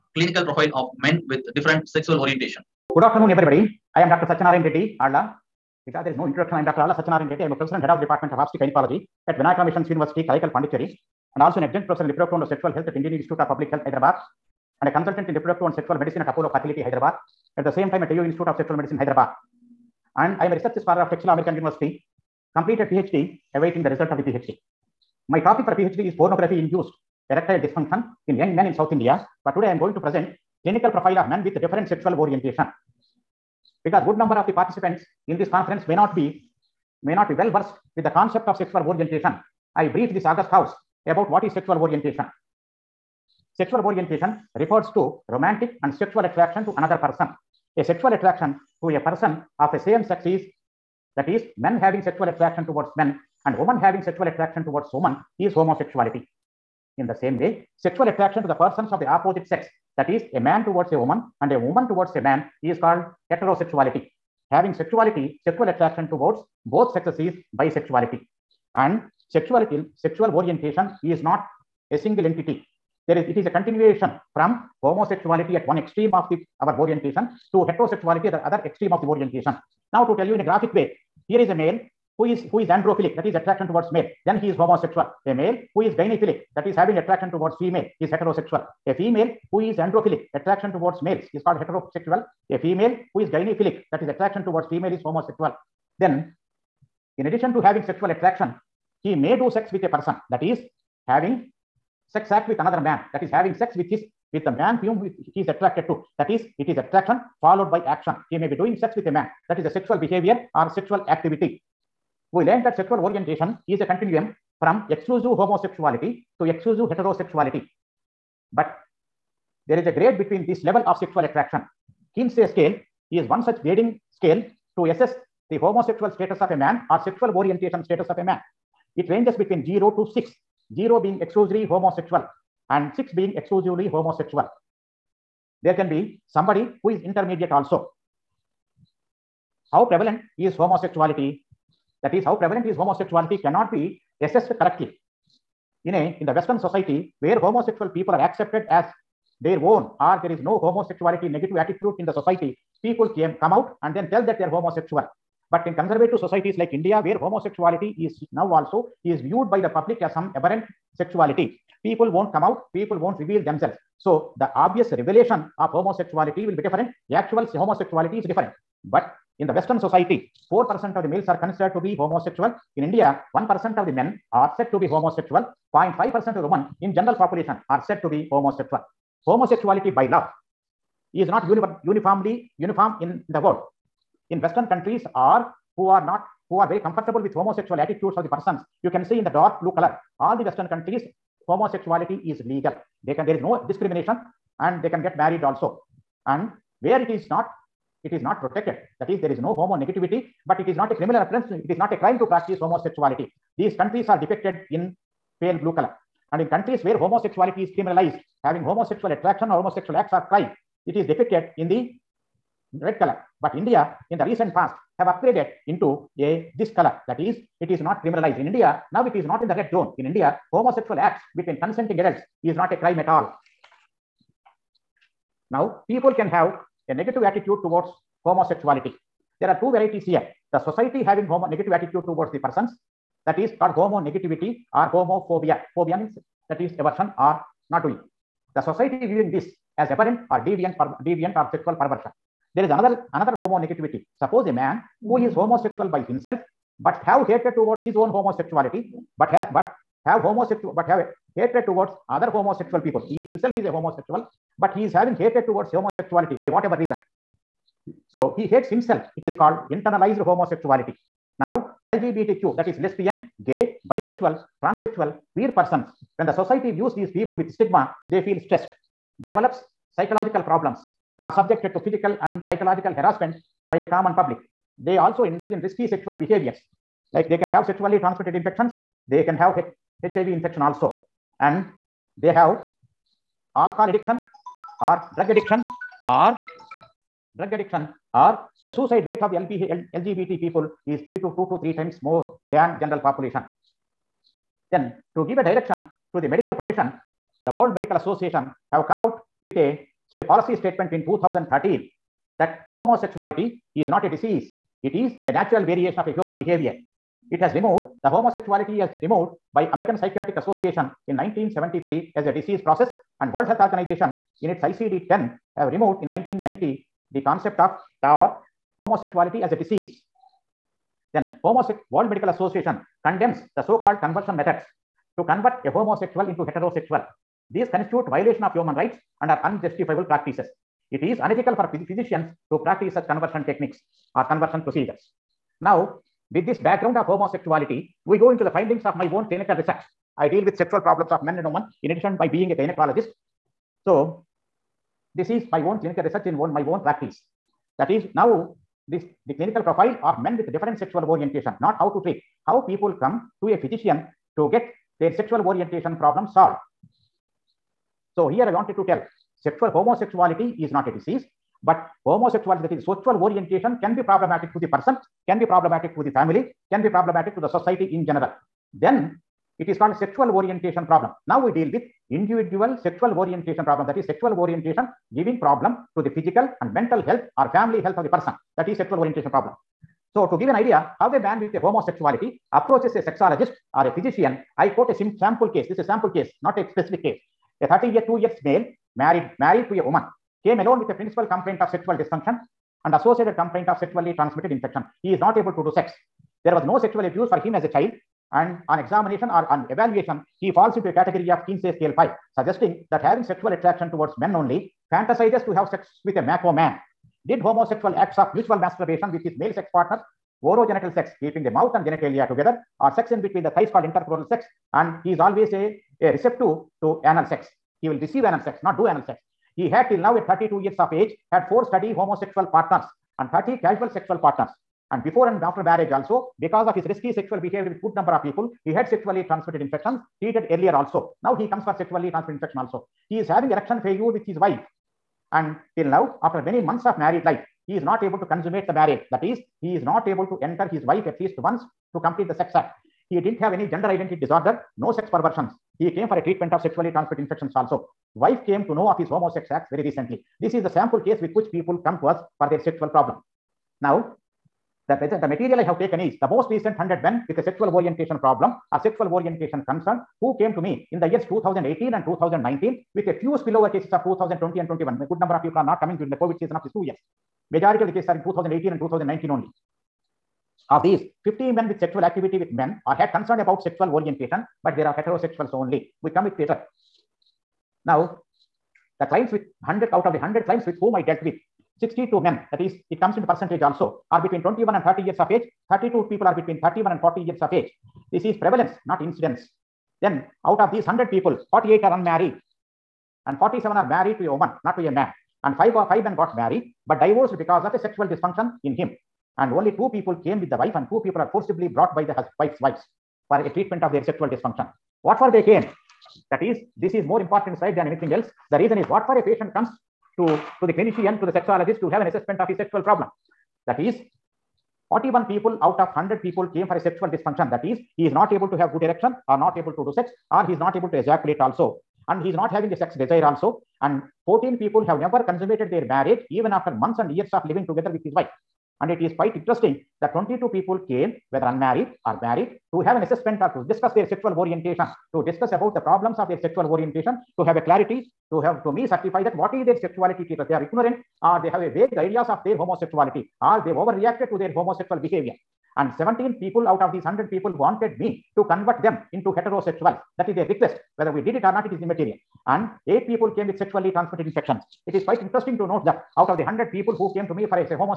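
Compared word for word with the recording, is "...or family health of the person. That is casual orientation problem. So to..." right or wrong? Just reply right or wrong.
wrong.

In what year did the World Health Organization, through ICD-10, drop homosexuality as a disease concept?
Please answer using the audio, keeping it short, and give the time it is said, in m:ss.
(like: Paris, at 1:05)
1990, at 5:16.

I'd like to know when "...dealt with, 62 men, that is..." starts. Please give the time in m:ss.
8:01.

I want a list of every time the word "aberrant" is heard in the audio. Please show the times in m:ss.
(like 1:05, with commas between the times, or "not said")
2:40, 3:59.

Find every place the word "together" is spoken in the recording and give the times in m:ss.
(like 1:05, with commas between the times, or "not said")
6:52, 8:47.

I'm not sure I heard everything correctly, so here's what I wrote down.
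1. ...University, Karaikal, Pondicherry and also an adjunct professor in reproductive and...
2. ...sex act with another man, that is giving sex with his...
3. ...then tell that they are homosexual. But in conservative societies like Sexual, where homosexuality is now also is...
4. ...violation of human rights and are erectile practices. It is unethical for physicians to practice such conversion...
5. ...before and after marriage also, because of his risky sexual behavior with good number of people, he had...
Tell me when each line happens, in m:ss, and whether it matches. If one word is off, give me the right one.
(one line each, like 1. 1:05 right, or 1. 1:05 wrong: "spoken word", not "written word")
1. 0:09 right
2. 1:42 wrong: "having", not "giving"
3. 2:33 wrong: "India", not "Sexual"
4. 5:28 wrong: "unjustifiable", not "erectile"
5. 7:05 right.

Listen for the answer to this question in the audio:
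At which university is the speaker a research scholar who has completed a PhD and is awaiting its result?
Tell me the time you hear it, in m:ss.
0:21.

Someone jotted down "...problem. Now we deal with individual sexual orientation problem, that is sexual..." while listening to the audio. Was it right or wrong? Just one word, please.
right.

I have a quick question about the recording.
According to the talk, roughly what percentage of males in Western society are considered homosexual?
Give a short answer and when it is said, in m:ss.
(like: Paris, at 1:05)
4%, at 2:50.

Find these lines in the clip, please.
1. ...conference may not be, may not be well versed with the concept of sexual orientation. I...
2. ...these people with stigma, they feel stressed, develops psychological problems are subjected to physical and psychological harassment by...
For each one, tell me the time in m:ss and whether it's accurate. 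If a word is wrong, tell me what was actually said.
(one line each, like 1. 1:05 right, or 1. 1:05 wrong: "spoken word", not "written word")
1. 0:35 right
2. 4:26 right.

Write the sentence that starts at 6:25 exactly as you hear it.
This is a sample case, not a specific case.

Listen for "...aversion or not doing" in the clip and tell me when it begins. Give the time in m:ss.
3:56.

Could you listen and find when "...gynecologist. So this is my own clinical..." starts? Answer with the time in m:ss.
5:42.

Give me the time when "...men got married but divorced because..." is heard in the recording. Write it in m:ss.
8:16.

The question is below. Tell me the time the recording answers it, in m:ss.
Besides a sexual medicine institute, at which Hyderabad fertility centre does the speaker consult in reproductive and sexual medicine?
0:16.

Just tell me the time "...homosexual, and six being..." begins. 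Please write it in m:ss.
2:11.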